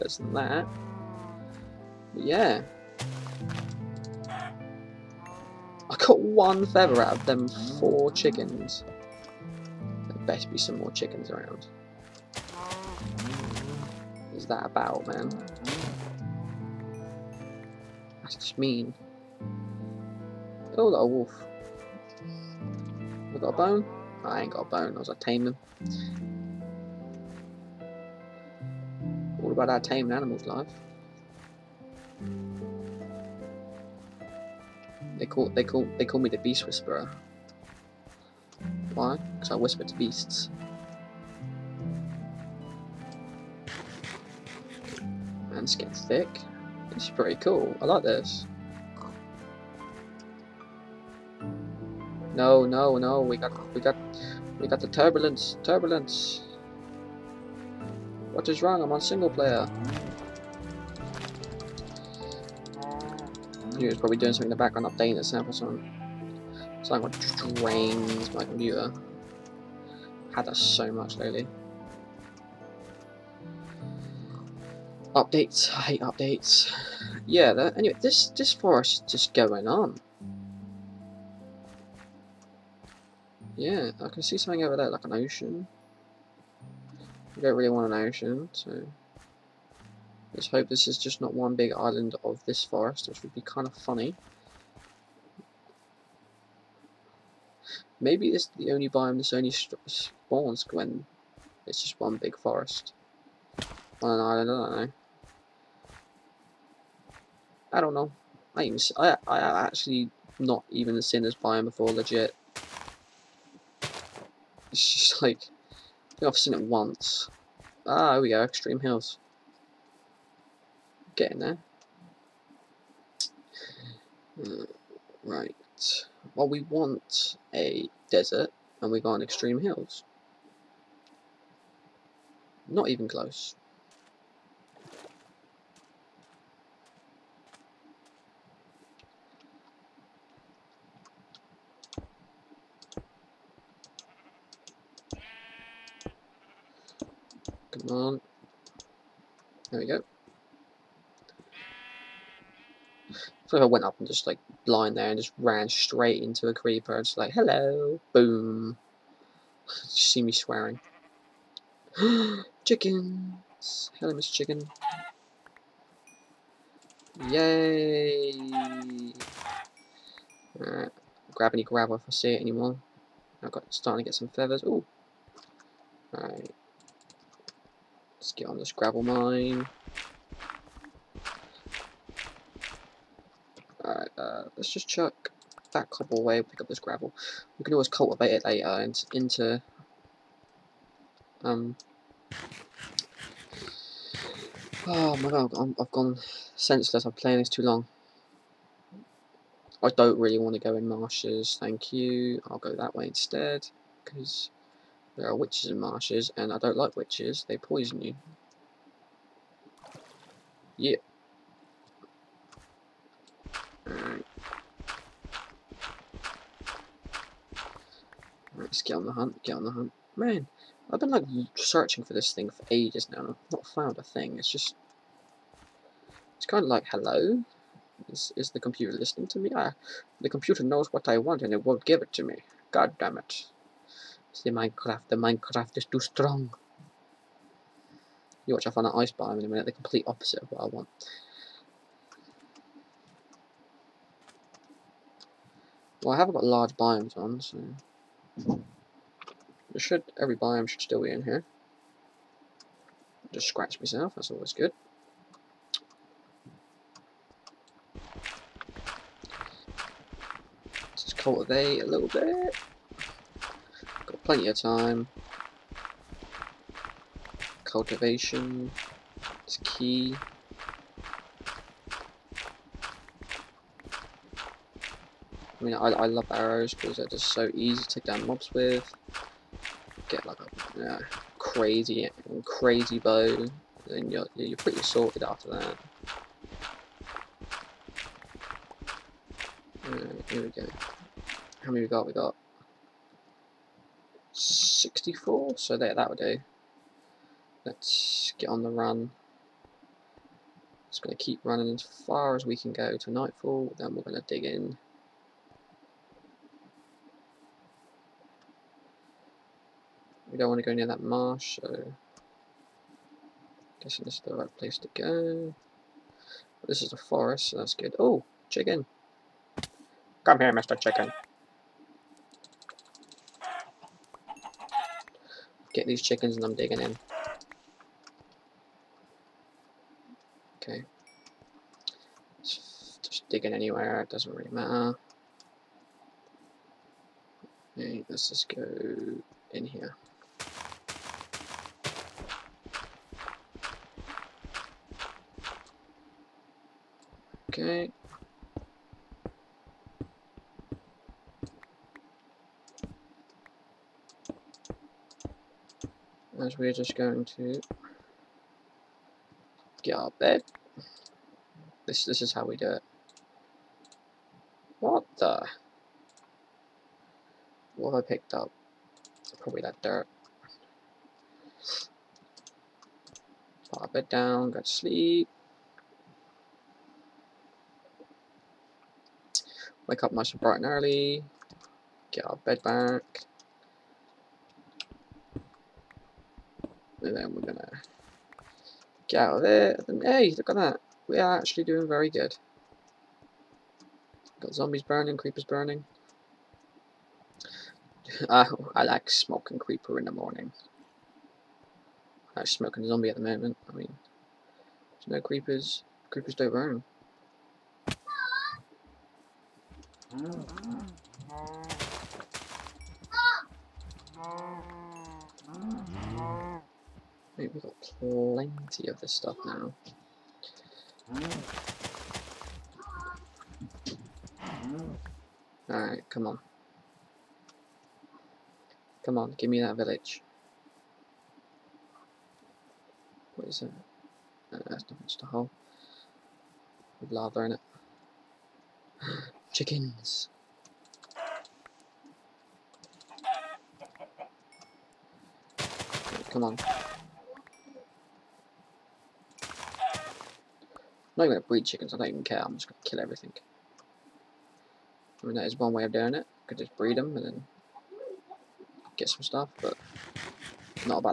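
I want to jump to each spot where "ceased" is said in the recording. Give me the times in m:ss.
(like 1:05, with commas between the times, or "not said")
not said.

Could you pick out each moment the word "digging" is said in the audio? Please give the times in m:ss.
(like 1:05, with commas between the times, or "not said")
5:26, 5:33.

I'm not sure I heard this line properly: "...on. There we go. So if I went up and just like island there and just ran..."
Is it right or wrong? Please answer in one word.
wrong.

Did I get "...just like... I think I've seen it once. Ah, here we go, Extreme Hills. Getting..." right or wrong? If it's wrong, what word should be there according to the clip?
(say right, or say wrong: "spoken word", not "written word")
right.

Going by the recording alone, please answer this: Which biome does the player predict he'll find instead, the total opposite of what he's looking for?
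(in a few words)
ice biome.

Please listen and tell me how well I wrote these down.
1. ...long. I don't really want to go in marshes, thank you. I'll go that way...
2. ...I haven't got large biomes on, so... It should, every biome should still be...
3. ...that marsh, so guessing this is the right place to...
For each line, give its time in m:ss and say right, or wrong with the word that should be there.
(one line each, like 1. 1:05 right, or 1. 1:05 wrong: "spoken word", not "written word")
1. 3:17 right
2. 4:06 right
3. 5:10 right.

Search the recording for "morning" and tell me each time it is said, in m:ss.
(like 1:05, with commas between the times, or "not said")
6:40.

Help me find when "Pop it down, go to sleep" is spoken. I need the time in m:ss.
6:13.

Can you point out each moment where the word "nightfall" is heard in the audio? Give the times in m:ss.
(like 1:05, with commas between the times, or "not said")
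5:03.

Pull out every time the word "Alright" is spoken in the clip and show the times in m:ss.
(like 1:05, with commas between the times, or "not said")
2:50, 2:56, 3:03, 3:33, 7:05.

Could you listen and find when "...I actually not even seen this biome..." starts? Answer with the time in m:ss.
1:49.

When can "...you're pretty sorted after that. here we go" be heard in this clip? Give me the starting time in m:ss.
4:44.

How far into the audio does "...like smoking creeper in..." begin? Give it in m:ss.
6:38.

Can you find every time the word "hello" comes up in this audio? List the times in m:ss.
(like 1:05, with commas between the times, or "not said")
2:37, 2:43, 3:46.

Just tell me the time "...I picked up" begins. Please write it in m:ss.
6:08.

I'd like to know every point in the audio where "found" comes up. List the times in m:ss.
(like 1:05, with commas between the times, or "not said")
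3:43, 3:58.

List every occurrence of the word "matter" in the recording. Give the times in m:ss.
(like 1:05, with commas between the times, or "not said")
5:34.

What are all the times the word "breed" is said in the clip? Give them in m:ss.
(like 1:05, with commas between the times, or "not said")
7:31, 7:36.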